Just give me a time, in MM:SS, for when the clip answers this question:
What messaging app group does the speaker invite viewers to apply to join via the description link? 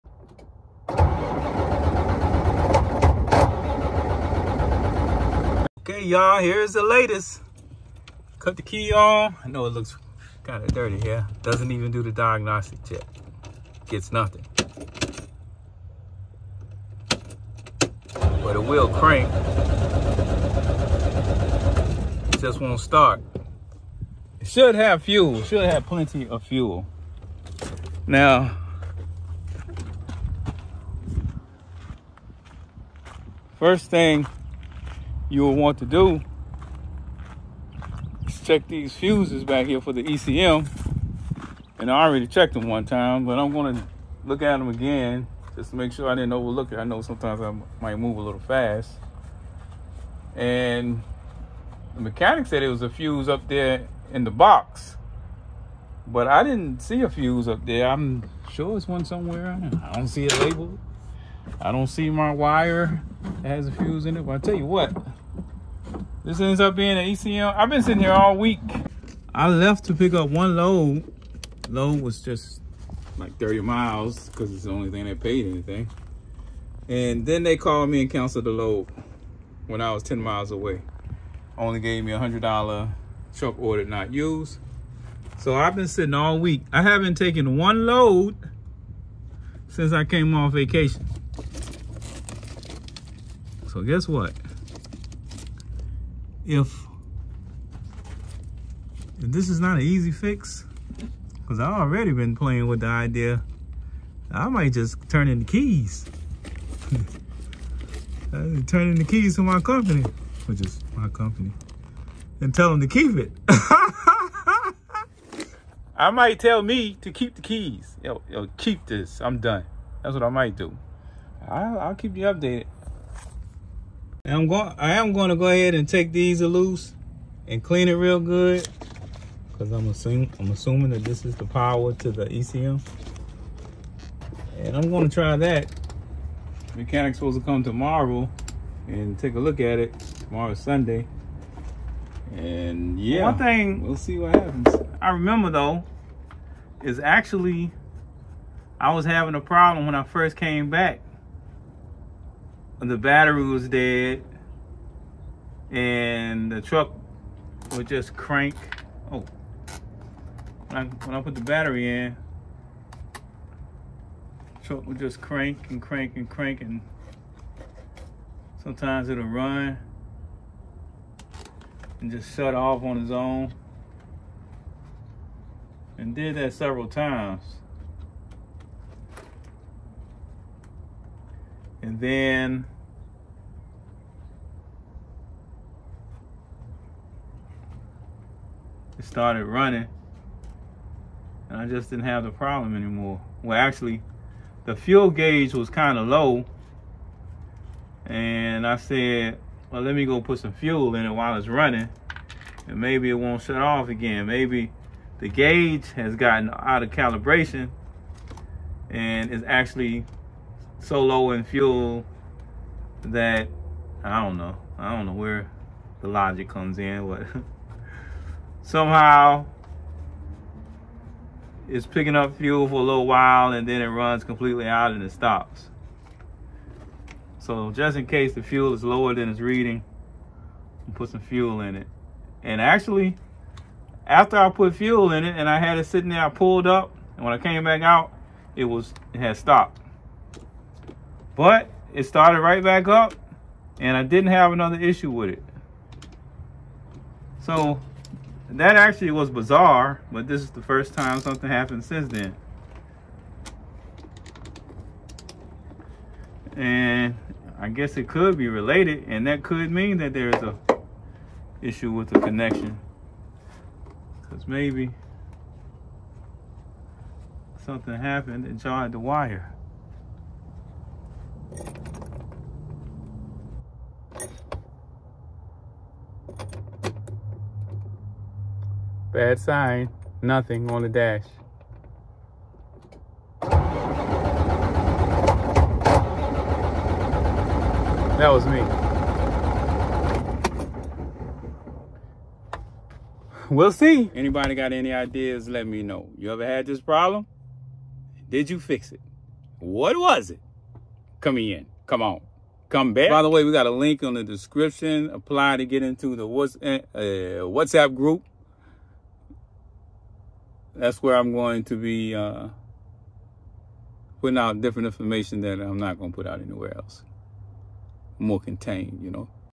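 05:07.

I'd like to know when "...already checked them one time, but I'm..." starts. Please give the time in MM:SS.
00:42.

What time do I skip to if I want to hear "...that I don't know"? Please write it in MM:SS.
03:33.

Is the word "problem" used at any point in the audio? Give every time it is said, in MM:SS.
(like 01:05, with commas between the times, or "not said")
02:29, 03:12, 04:56.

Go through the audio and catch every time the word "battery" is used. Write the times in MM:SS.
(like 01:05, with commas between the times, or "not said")
02:32, 02:41.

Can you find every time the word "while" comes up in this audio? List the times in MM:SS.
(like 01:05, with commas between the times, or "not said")
03:21, 03:43.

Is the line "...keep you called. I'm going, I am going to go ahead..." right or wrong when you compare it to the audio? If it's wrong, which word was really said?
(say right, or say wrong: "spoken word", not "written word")
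wrong: "updated", not "called".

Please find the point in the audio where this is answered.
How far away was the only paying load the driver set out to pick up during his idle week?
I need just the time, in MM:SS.
01:13.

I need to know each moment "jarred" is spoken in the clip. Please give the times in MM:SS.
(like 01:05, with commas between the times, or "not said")
04:28.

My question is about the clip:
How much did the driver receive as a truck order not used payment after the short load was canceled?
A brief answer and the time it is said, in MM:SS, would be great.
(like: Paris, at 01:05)
$100, at 01:22.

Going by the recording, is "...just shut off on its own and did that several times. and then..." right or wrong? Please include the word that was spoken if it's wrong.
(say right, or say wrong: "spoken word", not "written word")
right.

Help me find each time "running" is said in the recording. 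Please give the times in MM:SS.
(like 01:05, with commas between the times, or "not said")
03:09, 03:21.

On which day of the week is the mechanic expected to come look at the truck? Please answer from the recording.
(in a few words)
Sunday.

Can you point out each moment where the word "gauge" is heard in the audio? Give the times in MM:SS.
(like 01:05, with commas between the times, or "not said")
03:15, 03:25.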